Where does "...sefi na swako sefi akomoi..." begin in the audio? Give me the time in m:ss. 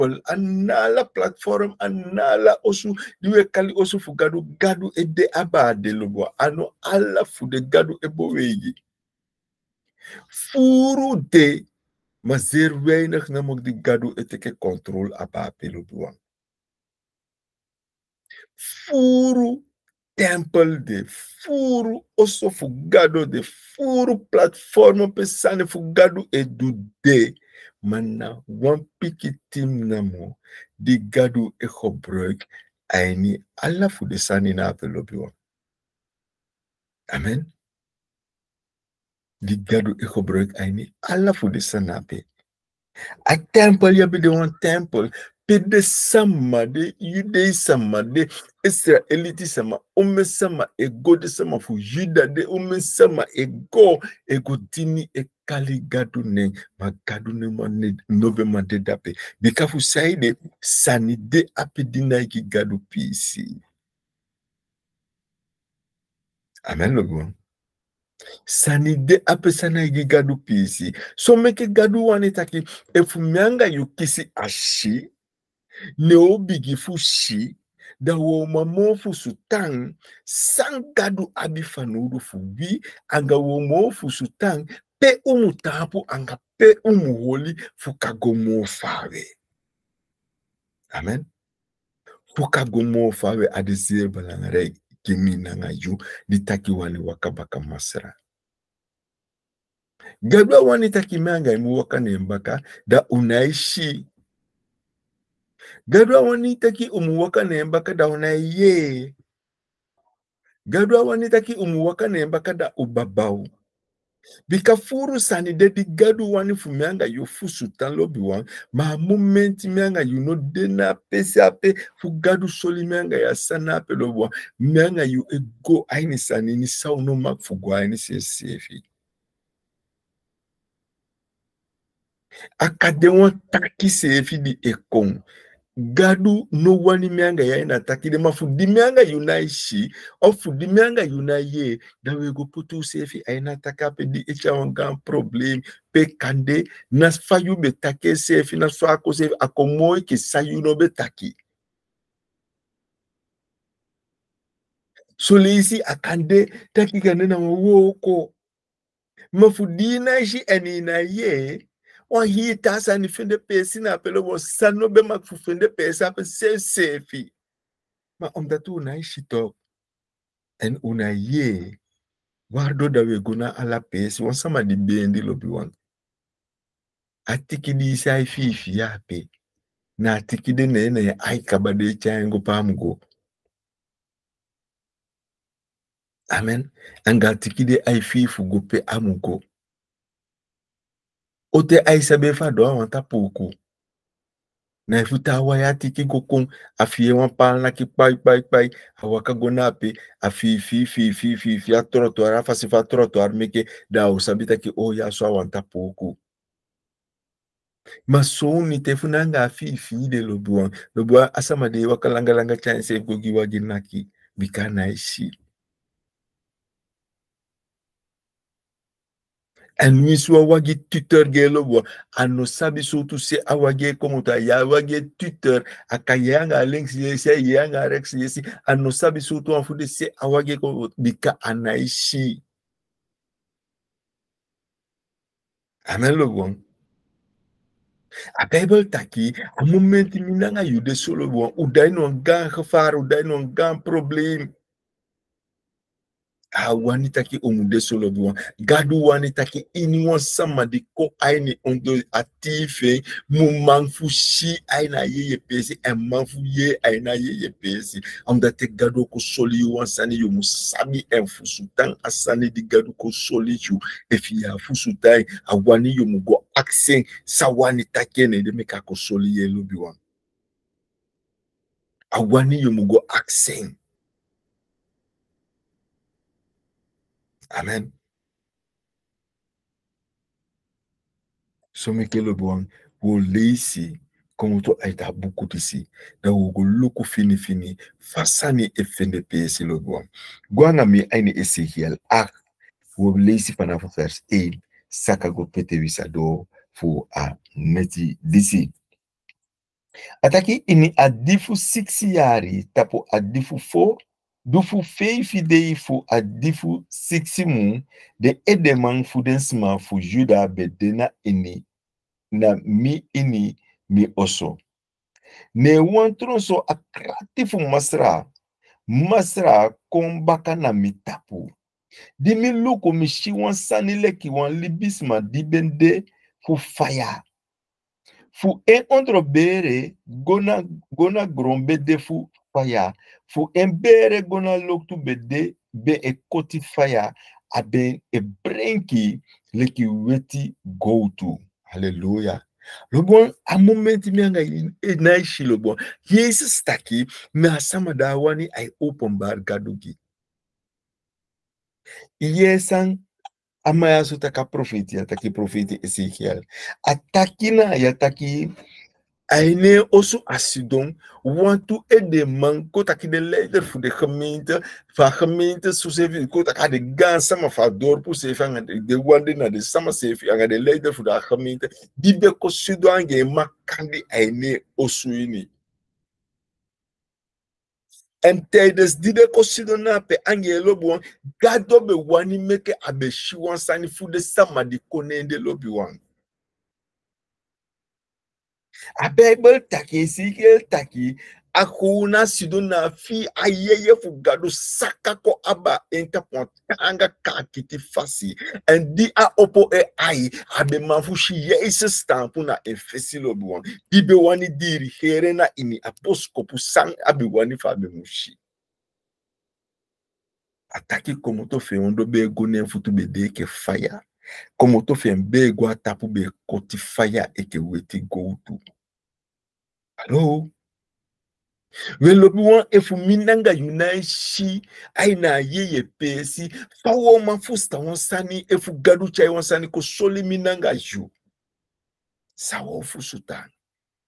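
2:28.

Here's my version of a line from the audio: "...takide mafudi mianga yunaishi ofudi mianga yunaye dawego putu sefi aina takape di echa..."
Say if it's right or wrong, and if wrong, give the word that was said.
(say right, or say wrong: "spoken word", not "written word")
right.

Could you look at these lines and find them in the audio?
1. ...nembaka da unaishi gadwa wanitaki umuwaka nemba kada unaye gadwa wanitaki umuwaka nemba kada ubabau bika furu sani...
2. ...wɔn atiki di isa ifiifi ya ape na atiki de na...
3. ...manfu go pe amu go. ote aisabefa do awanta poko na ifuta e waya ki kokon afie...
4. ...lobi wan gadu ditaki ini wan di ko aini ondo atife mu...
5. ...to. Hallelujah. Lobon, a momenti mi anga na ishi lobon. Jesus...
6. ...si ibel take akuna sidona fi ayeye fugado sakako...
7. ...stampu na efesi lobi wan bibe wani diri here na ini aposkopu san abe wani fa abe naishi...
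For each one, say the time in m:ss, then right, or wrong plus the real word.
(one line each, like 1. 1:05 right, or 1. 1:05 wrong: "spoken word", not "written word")
1. 1:41 right
2. 2:55 right
3. 3:07 wrong: "aifiifu", not "manfu"
4. 4:07 wrong: "wanitaki", not "ditaki"
5. 5:41 right
6. 6:30 right
7. 6:41 wrong: "mushi", not "naishi".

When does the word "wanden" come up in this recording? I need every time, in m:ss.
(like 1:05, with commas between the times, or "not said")
6:09.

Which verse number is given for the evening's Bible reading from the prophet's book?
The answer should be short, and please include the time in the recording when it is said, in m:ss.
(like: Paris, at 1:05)
8, at 4:53.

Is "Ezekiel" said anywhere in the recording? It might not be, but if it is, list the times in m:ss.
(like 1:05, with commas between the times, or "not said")
4:51, 5:55.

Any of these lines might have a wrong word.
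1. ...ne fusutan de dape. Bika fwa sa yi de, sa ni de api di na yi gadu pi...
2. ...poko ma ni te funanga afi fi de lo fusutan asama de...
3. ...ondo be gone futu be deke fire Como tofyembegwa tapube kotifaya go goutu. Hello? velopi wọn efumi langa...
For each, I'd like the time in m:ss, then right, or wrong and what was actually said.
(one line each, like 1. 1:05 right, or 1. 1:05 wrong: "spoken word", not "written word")
1. 0:57 wrong: "noveman", not "fusutan"
2. 3:25 wrong: "lobuan", not "fusutan"
3. 6:51 wrong: "nanga", not "langa".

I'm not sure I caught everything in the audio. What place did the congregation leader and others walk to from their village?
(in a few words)
Samasevi.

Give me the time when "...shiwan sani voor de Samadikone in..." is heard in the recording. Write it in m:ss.
6:23.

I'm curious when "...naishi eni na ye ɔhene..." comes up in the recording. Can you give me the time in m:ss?
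2:39.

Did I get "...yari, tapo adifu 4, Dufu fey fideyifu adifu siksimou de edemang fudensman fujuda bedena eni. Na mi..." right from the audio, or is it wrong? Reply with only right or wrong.
right.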